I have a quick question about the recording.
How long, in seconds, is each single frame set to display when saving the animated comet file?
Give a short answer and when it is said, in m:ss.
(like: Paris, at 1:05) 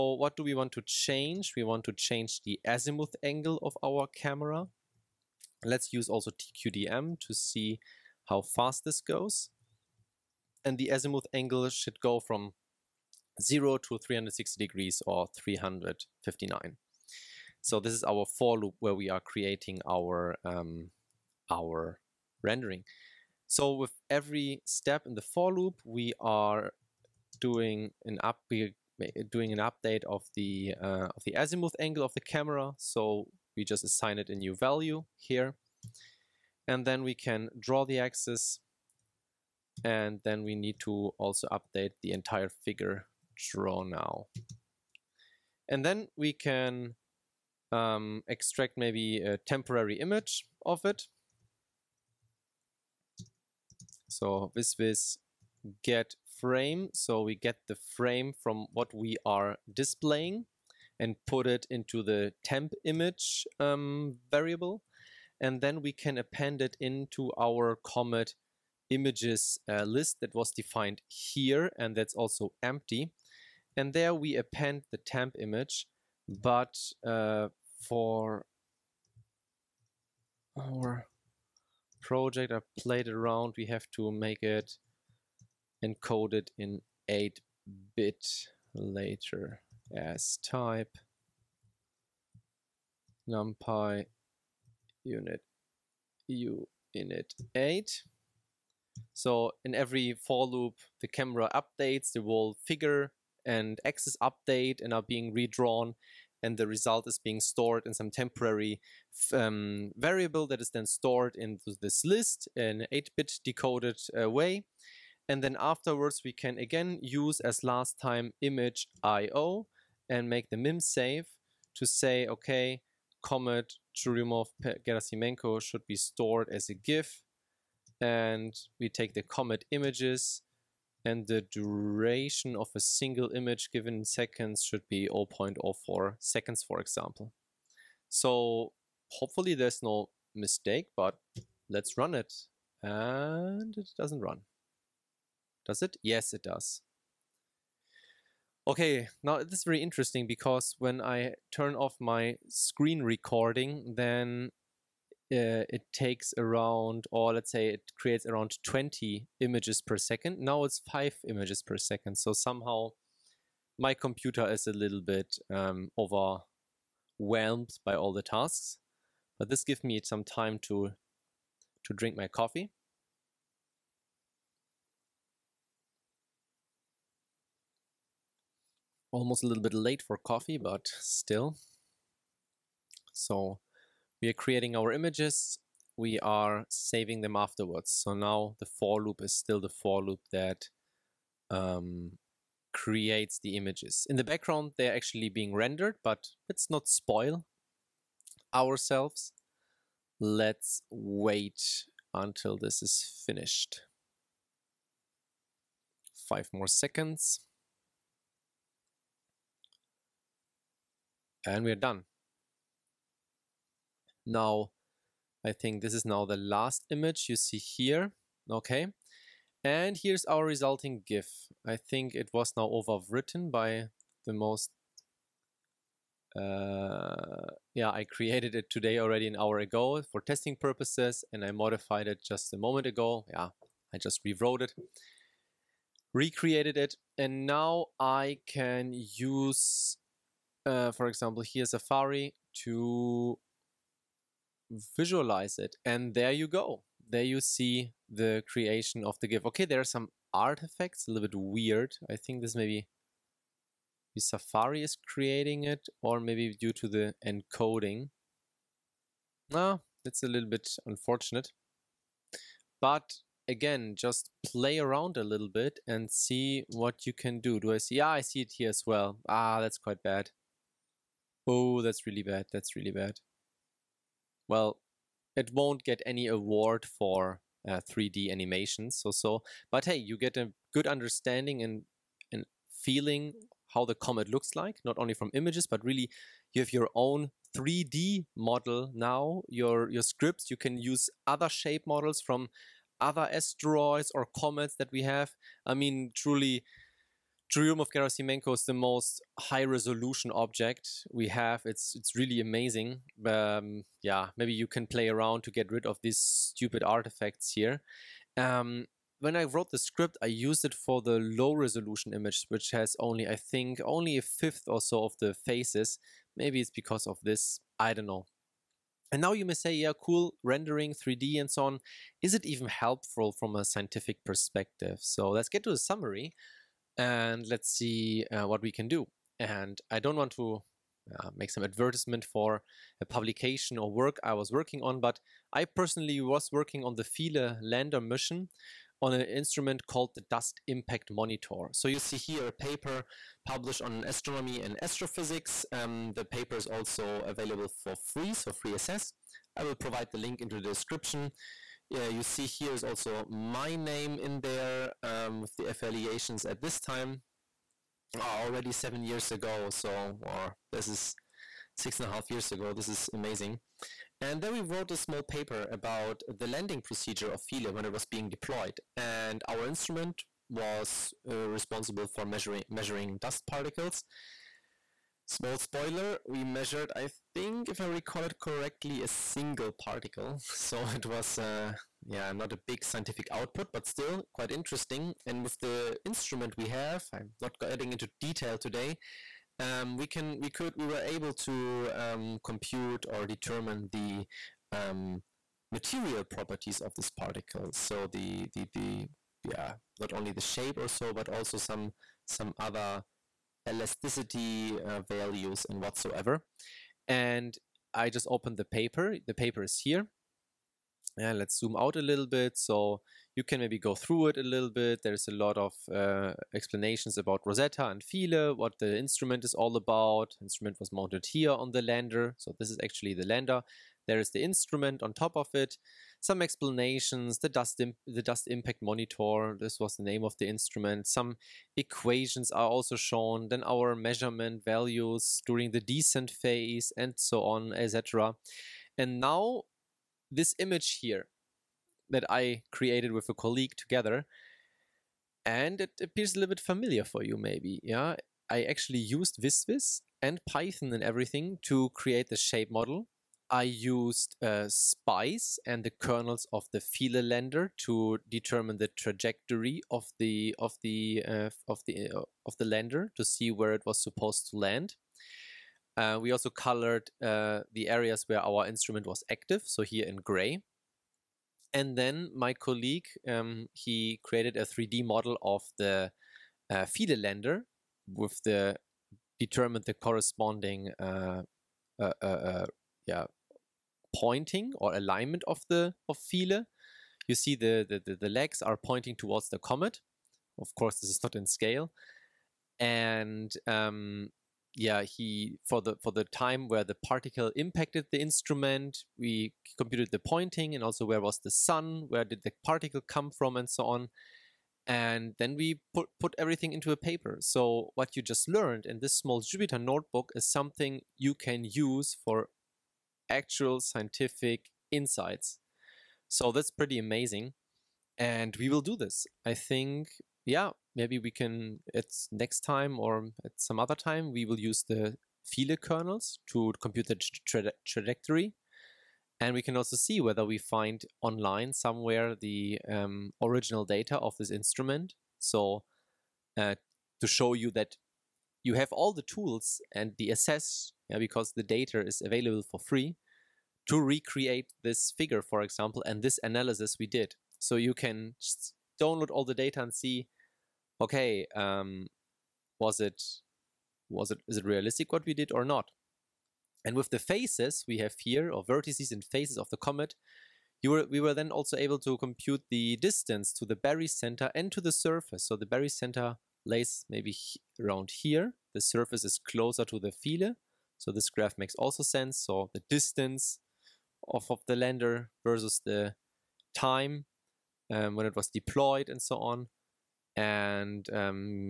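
0.04 seconds, at 2:15.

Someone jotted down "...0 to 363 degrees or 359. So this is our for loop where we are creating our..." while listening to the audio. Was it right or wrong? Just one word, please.
wrong.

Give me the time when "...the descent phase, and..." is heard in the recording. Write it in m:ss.
7:15.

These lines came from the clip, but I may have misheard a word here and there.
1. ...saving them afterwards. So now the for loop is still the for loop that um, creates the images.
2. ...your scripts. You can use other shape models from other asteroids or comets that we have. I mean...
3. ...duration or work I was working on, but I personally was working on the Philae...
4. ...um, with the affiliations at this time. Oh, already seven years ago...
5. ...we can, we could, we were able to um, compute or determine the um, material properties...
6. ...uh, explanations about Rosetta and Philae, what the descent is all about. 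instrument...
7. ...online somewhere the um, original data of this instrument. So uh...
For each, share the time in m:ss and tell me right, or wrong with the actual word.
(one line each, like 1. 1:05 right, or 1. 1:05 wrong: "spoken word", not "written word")
1. 3:06 right
2. 4:49 right
3. 5:33 wrong: "publication", not "duration"
4. 5:55 right
5. 6:29 right
6. 6:55 wrong: "instrument", not "descent"
7. 8:51 right.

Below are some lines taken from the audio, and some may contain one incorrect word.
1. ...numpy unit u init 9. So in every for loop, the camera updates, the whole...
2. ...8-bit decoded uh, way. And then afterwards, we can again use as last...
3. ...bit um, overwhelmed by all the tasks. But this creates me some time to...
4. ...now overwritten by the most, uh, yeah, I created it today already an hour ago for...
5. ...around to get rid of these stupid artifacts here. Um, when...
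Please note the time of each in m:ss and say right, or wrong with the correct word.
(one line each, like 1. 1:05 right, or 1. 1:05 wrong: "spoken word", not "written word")
1. 1:33 wrong: "8", not "9"
2. 1:52 right
3. 2:45 wrong: "gives", not "creates"
4. 3:42 right
5. 5:05 right.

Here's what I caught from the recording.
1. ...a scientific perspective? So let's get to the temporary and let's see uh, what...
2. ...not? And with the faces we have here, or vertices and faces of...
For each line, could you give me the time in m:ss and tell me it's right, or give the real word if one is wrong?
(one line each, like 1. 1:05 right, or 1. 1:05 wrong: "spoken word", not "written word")
1. 5:23 wrong: "summary", not "temporary"
2. 9:15 right.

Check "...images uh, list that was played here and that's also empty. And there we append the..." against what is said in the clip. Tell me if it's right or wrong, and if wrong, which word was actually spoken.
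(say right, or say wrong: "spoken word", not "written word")
wrong: "defined", not "played".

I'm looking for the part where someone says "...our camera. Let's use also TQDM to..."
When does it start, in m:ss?
0:03.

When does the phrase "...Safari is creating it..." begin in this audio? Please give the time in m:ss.
4:14.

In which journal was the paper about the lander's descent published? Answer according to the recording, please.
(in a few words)
Astronomy and Astrophysics.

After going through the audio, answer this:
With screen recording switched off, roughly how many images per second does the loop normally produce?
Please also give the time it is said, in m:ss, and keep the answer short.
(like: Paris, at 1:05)
20, at 2:38.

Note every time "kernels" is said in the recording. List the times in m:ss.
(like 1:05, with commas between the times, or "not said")
7:35, 8:45.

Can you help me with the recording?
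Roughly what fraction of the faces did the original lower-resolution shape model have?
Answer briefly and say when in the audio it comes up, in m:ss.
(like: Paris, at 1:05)
a fifth, at 5:14.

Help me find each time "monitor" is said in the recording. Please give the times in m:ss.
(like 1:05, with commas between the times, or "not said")
5:41, 7:08.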